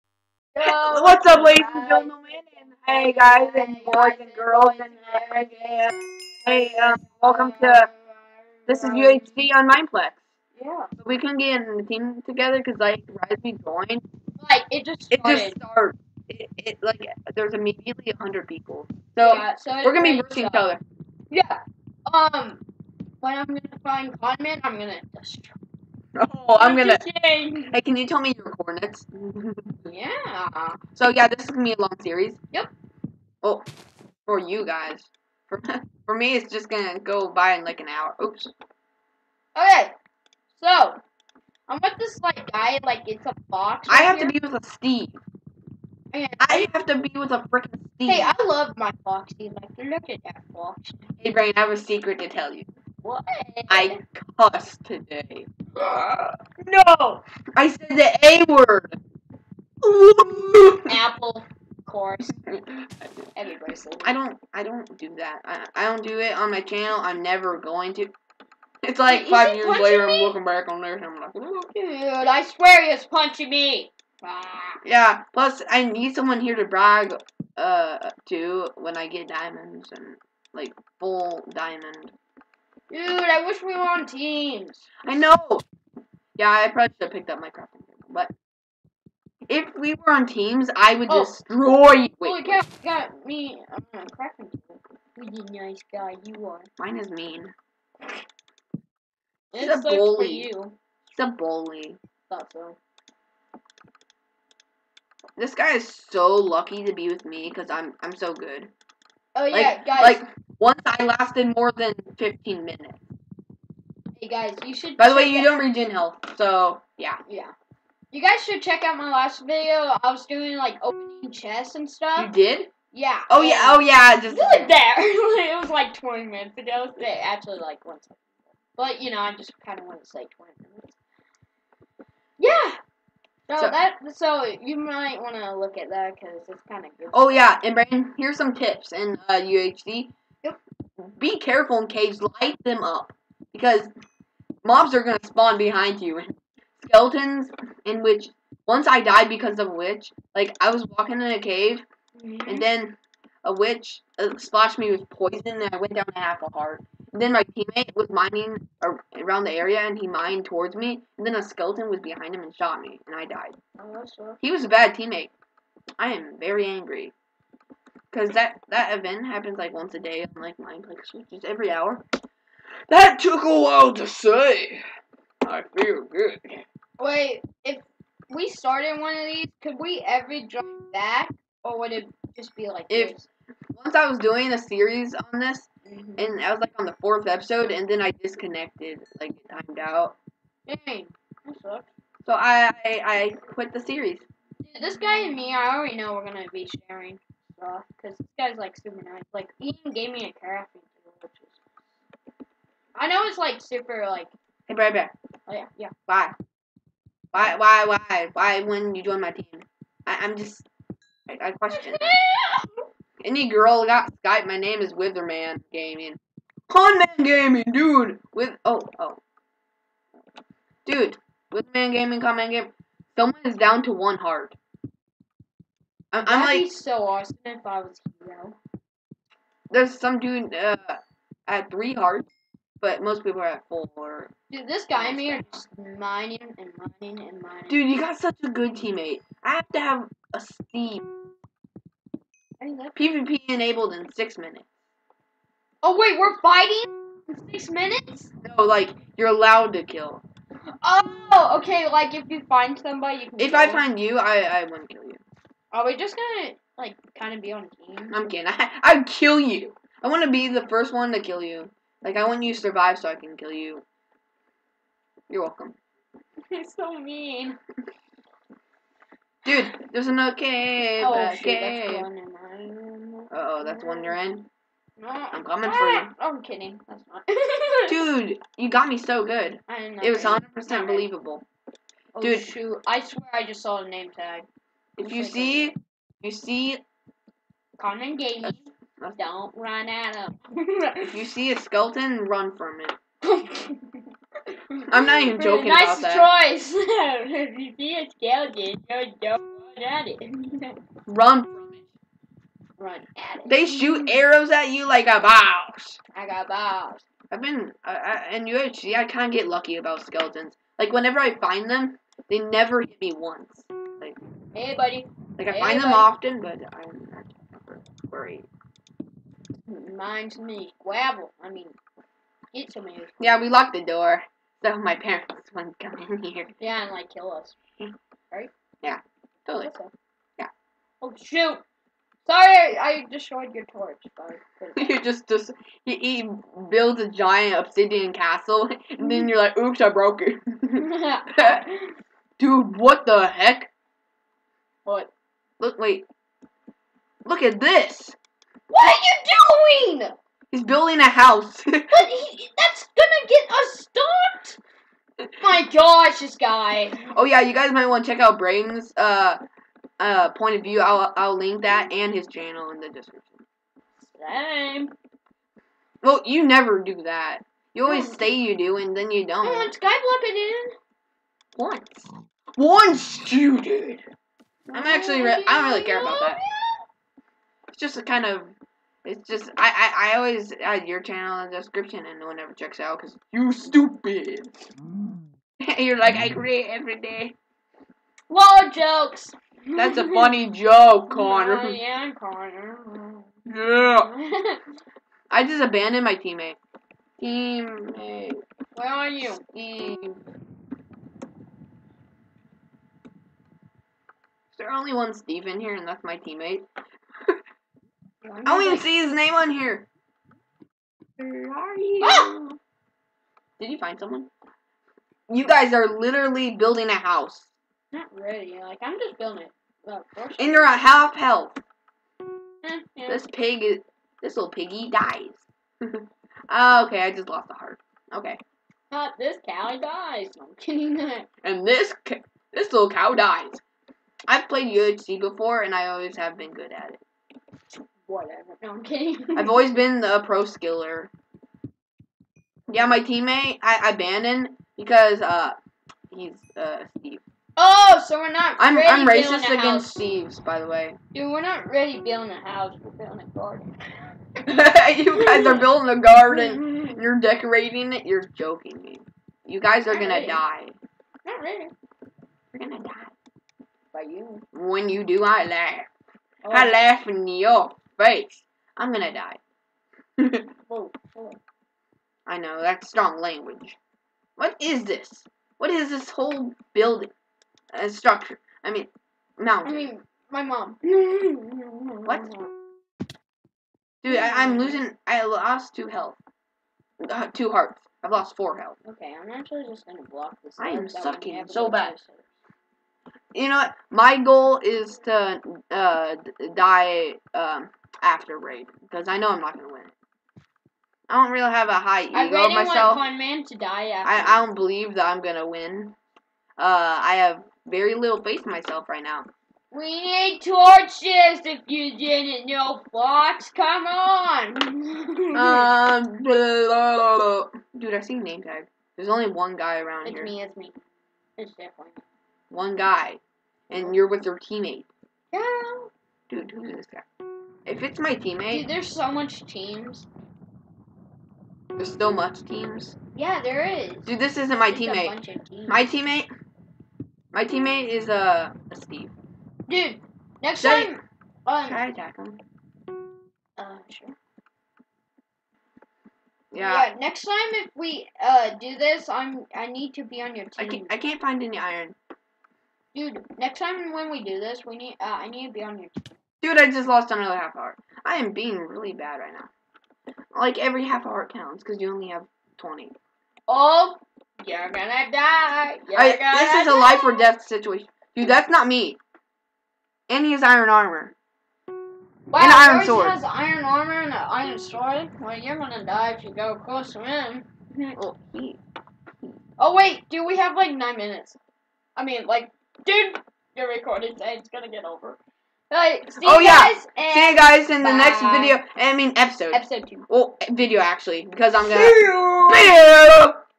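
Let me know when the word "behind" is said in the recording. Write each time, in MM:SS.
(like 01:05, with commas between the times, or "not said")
02:25, 02:41.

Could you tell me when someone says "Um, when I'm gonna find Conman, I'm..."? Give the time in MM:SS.
00:22.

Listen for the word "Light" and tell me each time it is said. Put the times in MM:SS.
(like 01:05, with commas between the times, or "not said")
02:22.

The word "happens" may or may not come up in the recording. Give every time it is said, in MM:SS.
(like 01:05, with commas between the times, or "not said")
02:49.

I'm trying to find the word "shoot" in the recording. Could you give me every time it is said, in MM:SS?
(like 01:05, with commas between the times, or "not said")
04:42, 05:03, 05:31.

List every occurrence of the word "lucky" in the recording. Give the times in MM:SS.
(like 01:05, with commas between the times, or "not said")
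01:46, 05:09.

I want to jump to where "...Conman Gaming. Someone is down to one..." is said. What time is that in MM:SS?
03:42.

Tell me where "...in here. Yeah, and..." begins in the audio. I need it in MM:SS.
05:26.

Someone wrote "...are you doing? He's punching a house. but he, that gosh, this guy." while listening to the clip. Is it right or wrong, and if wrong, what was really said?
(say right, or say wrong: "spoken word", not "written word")
wrong: "building", not "punching".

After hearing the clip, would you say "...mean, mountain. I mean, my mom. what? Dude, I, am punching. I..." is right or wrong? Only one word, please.
wrong.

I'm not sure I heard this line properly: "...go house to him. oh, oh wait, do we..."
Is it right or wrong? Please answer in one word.
wrong.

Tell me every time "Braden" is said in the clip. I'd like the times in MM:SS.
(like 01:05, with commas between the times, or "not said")
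00:51, 05:58.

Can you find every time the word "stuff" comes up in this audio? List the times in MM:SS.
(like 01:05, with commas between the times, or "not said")
02:01, 03:17.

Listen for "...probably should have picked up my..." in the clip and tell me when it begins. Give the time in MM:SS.
01:26.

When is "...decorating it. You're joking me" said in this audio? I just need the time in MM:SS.
07:37.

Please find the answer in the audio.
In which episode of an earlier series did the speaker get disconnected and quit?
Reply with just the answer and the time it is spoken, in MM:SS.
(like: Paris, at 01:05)
Fourth, at 03:07.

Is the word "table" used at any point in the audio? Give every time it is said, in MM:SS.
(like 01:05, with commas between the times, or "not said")
01:27, 01:34.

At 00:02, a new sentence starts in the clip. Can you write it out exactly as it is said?
And hey, guys, and boys and girls, and hey, um, hey welcome to this is UHC on Mineplex.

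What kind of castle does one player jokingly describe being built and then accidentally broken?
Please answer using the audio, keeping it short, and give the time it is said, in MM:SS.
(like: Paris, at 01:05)
Obsidian castle, at 05:37.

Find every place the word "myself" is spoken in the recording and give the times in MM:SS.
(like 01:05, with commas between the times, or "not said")
08:22, 08:28.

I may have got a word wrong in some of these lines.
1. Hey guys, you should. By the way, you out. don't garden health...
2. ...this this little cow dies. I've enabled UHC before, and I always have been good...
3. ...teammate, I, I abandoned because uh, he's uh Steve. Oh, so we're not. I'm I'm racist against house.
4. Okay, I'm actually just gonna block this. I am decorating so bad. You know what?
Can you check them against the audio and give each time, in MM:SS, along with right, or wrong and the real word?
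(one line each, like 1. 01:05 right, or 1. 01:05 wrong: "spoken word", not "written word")
1. 01:54 wrong: "regen", not "garden"
2. 07:11 wrong: "played", not "enabled"
3. 07:22 right
4. 08:08 wrong: "sucking", not "decorating".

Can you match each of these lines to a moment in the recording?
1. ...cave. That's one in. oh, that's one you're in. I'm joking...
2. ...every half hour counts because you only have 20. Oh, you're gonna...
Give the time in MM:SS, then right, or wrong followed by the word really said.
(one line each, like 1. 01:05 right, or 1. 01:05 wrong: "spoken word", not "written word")
1. 04:31 wrong: "coming", not "joking"
2. 09:20 right.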